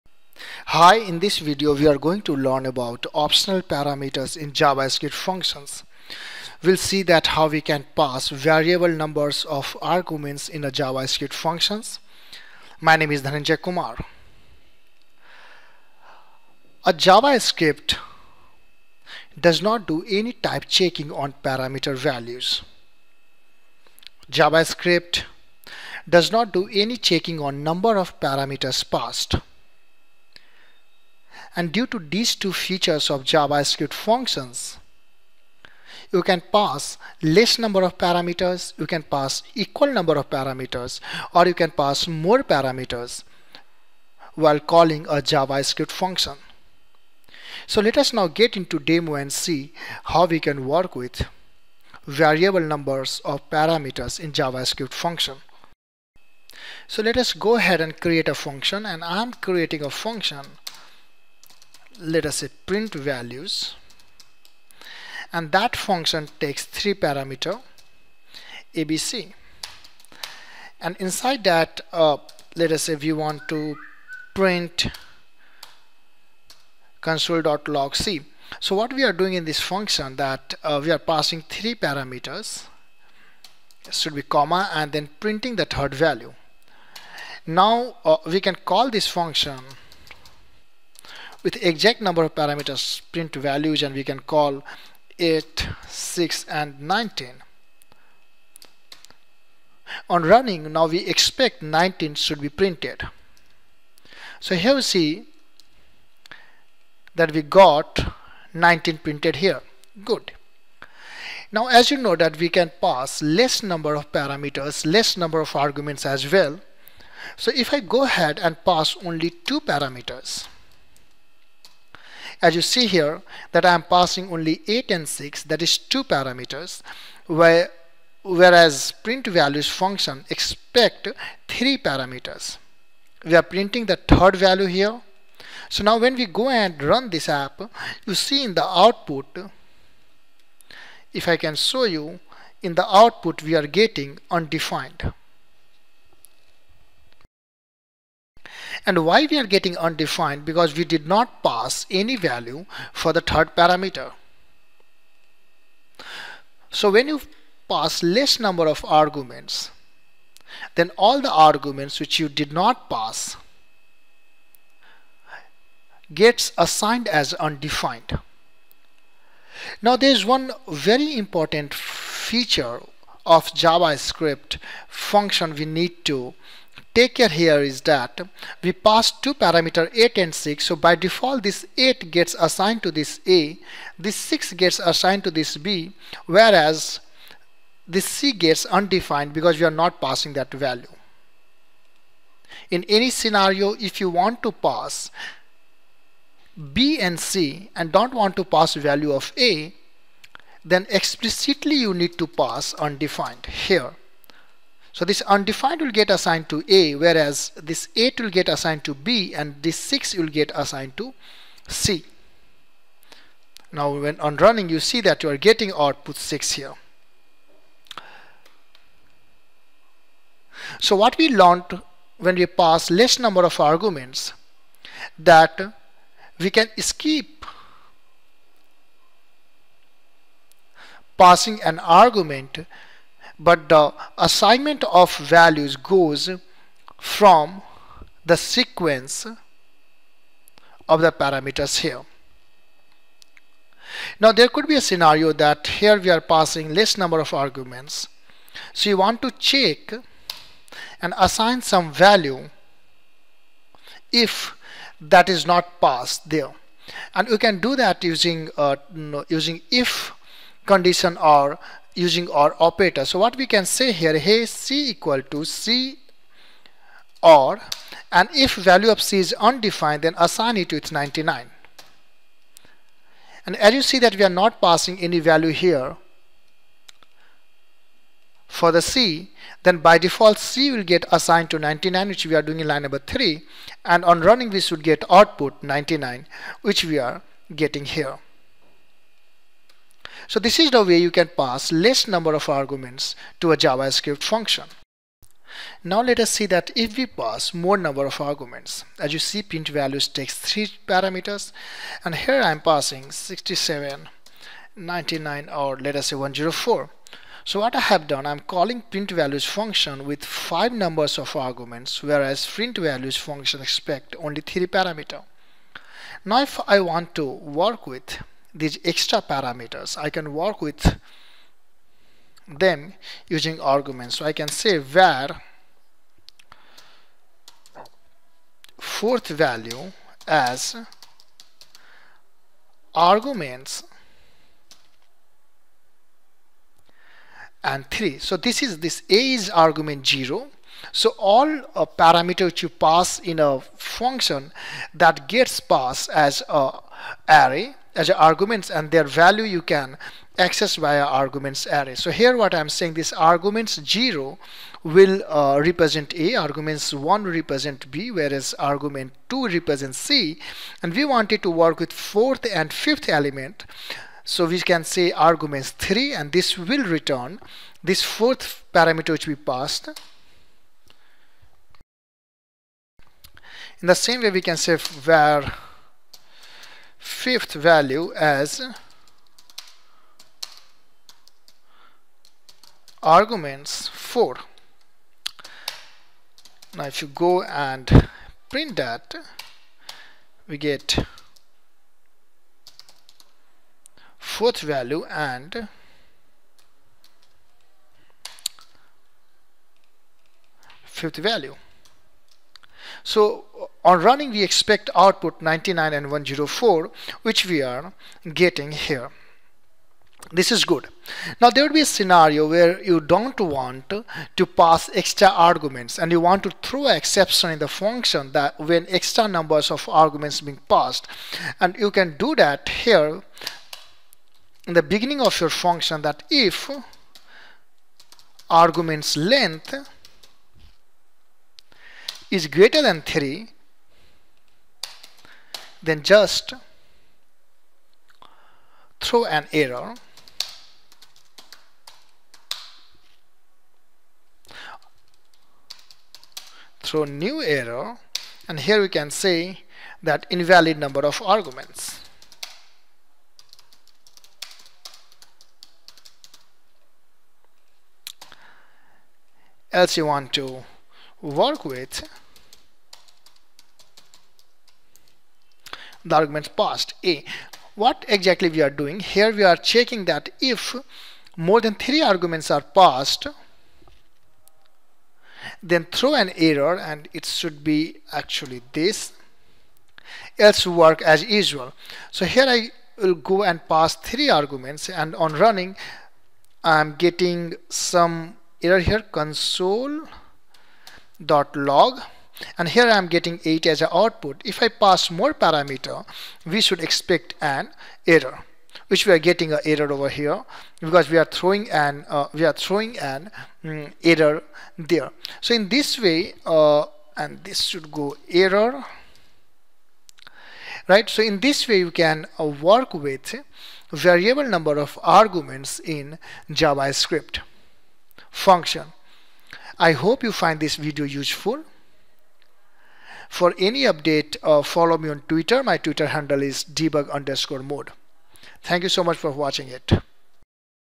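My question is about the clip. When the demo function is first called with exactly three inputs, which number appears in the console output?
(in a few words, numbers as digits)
19.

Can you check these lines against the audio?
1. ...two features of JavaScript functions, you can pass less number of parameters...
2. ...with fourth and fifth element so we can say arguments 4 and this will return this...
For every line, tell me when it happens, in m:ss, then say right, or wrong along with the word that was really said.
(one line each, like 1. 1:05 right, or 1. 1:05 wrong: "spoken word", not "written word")
1. 0:32 right
2. 6:01 wrong: "3", not "4".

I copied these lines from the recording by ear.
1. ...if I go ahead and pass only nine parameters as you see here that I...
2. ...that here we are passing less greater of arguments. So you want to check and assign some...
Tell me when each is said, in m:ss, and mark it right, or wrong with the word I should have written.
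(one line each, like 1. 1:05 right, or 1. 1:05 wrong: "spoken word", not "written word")
1. 1:57 wrong: "two", not "nine"
2. 4:05 wrong: "number", not "greater".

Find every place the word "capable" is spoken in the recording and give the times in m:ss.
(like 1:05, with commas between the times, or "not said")
not said.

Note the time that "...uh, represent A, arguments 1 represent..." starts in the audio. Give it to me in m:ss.
5:55.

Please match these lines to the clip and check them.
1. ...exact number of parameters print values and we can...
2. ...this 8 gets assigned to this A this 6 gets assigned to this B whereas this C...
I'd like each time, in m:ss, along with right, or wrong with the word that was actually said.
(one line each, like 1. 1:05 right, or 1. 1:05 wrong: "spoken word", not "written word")
1. 1:31 right
2. 3:01 right.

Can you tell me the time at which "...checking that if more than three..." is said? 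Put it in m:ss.
7:49.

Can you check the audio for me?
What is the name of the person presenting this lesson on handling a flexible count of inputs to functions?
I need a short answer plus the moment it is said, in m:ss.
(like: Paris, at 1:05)
Dhananjay Kumar, at 0:13.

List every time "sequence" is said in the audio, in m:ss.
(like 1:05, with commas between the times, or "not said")
3:58.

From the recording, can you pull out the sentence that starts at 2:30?
Because we did not pass any value for the third parameter.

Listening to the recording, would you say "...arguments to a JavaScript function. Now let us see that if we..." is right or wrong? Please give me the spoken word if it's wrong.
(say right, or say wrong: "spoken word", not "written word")
right.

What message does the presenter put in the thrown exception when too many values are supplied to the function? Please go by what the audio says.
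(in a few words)
invalid number of arguments.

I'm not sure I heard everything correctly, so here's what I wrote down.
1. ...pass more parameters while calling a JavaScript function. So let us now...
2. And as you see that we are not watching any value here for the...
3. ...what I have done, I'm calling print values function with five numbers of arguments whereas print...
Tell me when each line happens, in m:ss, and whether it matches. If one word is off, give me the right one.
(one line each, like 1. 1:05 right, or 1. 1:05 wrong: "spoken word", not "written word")
1. 0:41 right
2. 4:33 wrong: "passing", not "watching"
3. 5:07 right.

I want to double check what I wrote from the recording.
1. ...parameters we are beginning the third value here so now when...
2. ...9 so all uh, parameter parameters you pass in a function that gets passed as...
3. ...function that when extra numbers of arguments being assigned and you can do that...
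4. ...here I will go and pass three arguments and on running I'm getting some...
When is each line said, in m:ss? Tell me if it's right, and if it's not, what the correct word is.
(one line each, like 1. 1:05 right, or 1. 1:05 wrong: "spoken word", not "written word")
1. 2:11 wrong: "printing", not "beginning"
2. 5:40 wrong: "0", not "9"
3. 6:57 wrong: "passed", not "assigned"
4. 8:02 right.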